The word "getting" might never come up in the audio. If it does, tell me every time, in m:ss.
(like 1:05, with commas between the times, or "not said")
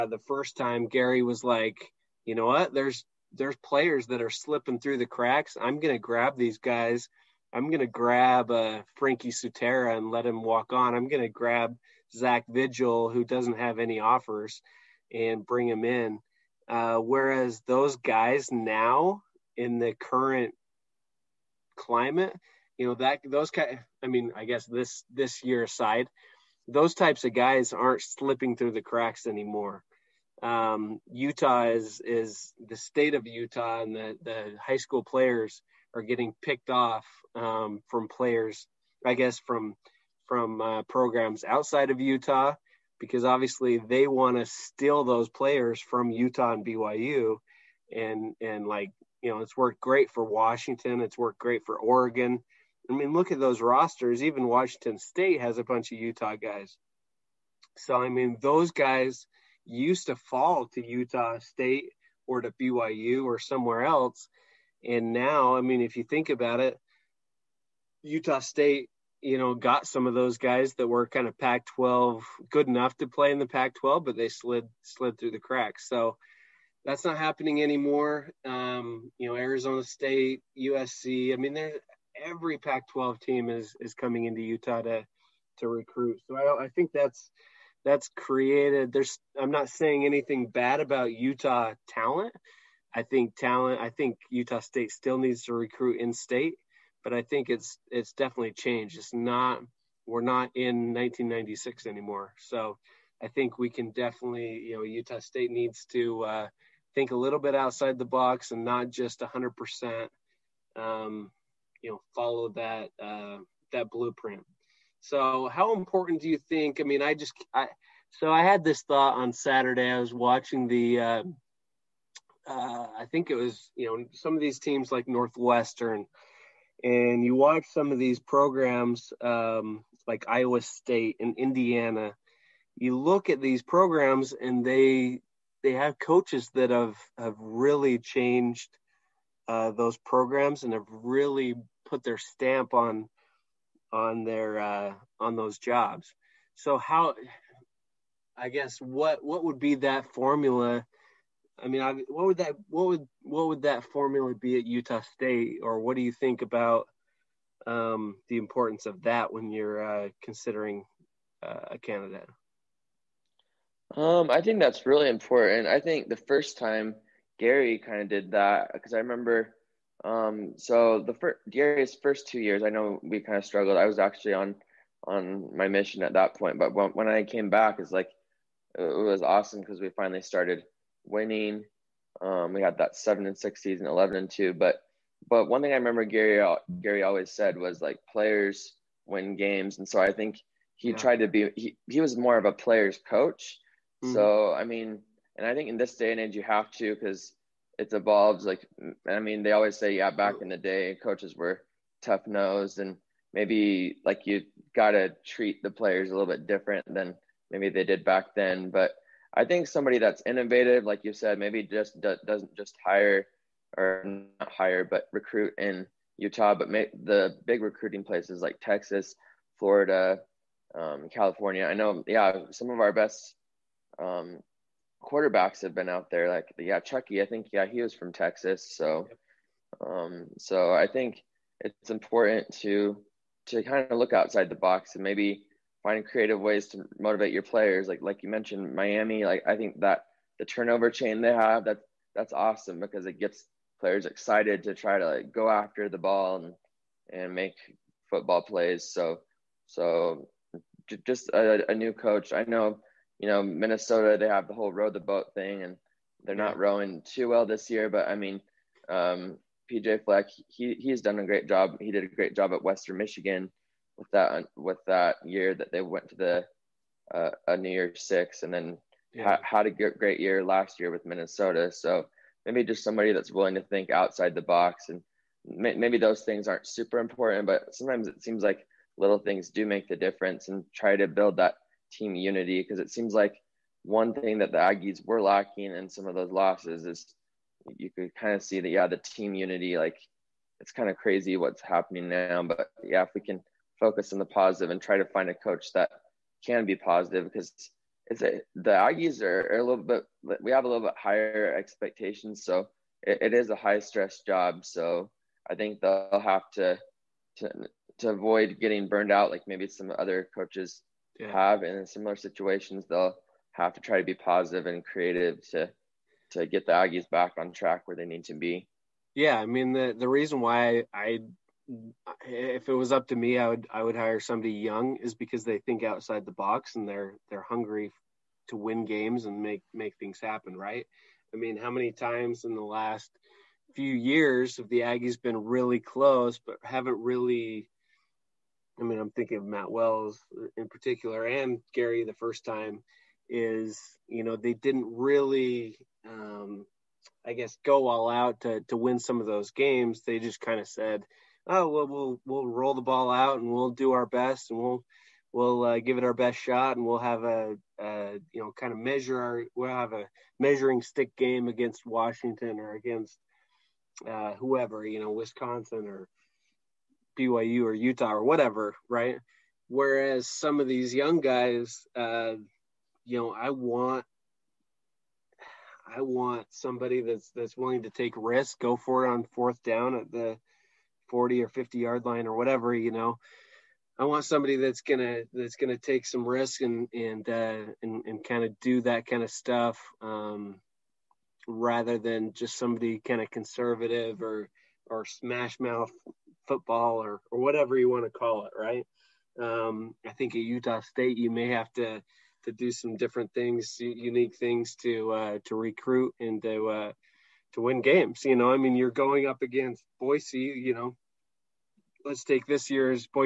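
0:36, 5:08.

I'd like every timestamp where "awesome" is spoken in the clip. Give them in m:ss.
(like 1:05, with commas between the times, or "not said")
2:59, 4:02.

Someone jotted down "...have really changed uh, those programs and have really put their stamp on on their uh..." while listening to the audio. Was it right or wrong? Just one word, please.
right.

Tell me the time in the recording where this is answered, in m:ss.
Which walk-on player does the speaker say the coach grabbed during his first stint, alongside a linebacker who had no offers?
0:08.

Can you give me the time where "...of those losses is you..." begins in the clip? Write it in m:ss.
4:46.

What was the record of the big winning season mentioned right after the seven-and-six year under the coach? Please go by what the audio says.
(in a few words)
11 and 2.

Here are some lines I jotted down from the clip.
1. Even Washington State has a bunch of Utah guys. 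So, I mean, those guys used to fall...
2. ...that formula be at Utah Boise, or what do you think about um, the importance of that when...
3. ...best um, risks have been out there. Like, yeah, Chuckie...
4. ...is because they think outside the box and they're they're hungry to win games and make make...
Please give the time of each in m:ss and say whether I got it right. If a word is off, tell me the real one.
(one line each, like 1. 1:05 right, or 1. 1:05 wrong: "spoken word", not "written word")
1. 0:54 right
2. 2:33 wrong: "State", not "Boise"
3. 3:42 wrong: "quarterbacks", not "risks"
4. 5:24 right.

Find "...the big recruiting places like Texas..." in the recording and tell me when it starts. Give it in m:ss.
3:37.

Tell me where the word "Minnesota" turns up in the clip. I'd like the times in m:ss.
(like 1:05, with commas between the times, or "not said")
4:13, 4:31.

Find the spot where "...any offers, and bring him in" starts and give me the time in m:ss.
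0:13.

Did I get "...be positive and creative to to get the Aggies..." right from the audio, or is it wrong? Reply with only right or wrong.
right.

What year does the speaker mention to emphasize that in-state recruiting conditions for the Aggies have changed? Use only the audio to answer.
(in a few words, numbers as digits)
1996.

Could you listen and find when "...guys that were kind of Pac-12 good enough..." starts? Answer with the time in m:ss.
1:10.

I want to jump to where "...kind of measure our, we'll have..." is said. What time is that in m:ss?
5:58.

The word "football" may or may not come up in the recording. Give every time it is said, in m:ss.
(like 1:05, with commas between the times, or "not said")
4:08, 6:36.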